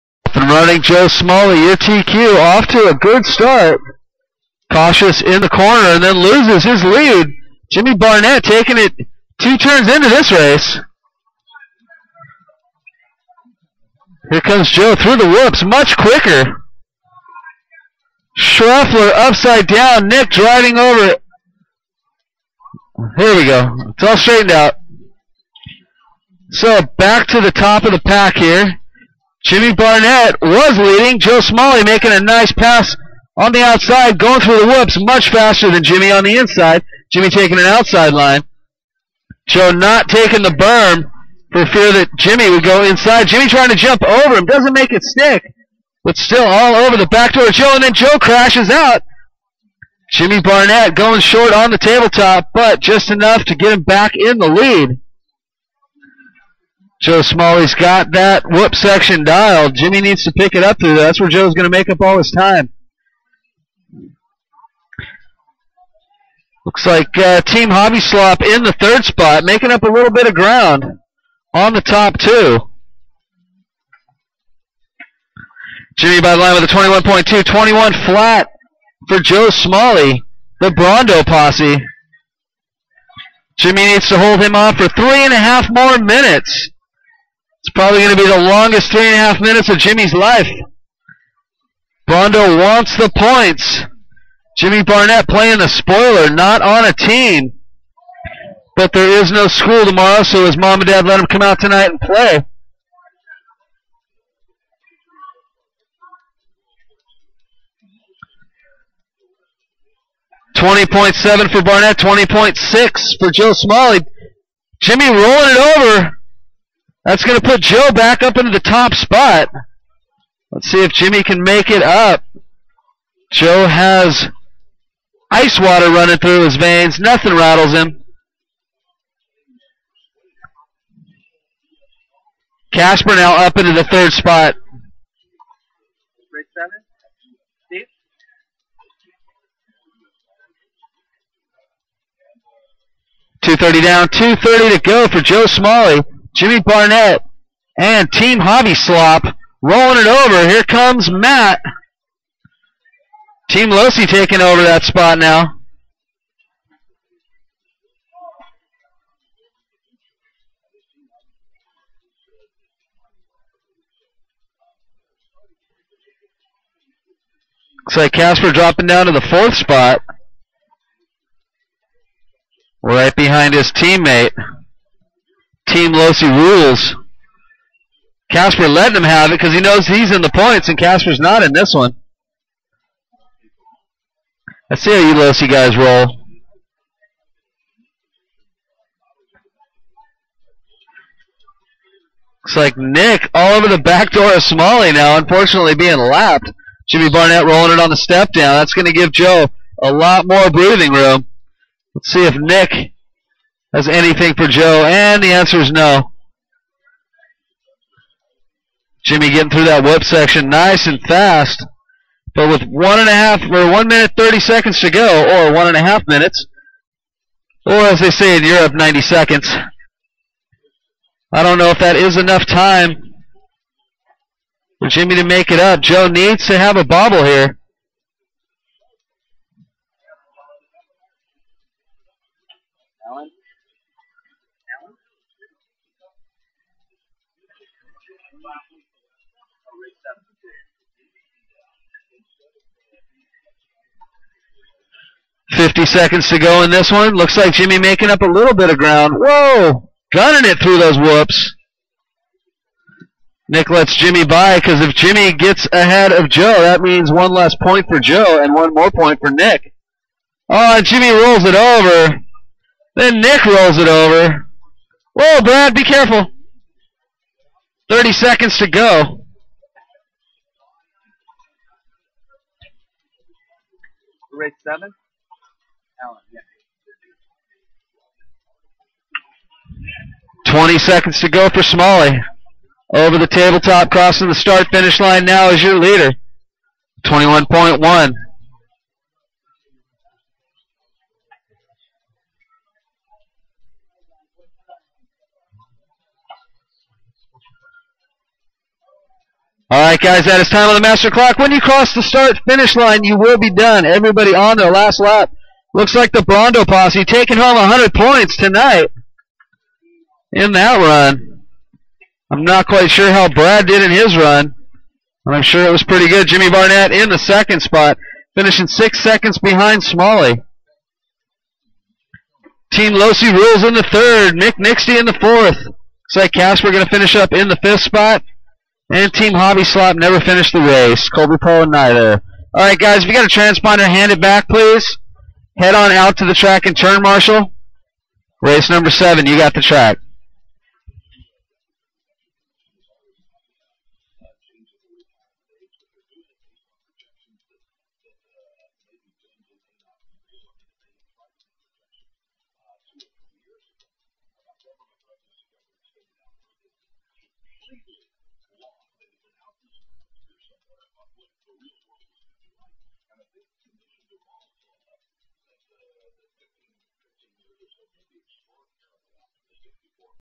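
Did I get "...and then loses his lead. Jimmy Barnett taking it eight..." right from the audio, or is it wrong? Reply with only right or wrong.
wrong.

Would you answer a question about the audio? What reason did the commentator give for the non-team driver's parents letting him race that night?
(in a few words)
No school tomorrow.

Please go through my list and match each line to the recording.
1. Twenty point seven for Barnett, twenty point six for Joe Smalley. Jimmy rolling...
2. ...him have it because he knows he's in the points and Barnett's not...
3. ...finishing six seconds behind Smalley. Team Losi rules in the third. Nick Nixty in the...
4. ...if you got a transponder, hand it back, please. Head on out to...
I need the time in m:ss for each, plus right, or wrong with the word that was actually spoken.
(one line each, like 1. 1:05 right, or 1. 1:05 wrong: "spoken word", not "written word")
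1. 1:50 right
2. 2:58 wrong: "Casper", not "Barnett"
3. 5:18 right
4. 5:33 right.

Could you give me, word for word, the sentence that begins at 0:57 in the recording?
Joe Smalley's got that whoop section dialed.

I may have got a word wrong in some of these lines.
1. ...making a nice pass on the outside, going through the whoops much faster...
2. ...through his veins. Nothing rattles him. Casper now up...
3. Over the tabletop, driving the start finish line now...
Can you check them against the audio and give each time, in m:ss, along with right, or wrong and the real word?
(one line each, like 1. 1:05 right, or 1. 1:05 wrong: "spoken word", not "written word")
1. 0:31 right
2. 2:06 right
3. 4:42 wrong: "crossing", not "driving".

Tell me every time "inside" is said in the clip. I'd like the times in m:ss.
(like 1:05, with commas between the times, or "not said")
0:36, 0:42.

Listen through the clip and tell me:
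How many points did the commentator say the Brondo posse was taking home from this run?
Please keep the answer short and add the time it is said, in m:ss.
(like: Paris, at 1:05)
100, at 5:07.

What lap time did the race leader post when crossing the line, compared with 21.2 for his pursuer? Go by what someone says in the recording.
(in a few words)
21 flat.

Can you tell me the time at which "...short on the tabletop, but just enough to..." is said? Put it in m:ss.
0:51.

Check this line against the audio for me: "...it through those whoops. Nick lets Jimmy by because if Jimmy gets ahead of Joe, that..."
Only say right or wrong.
right.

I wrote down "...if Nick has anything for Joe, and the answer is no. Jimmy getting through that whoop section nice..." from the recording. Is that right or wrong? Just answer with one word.
right.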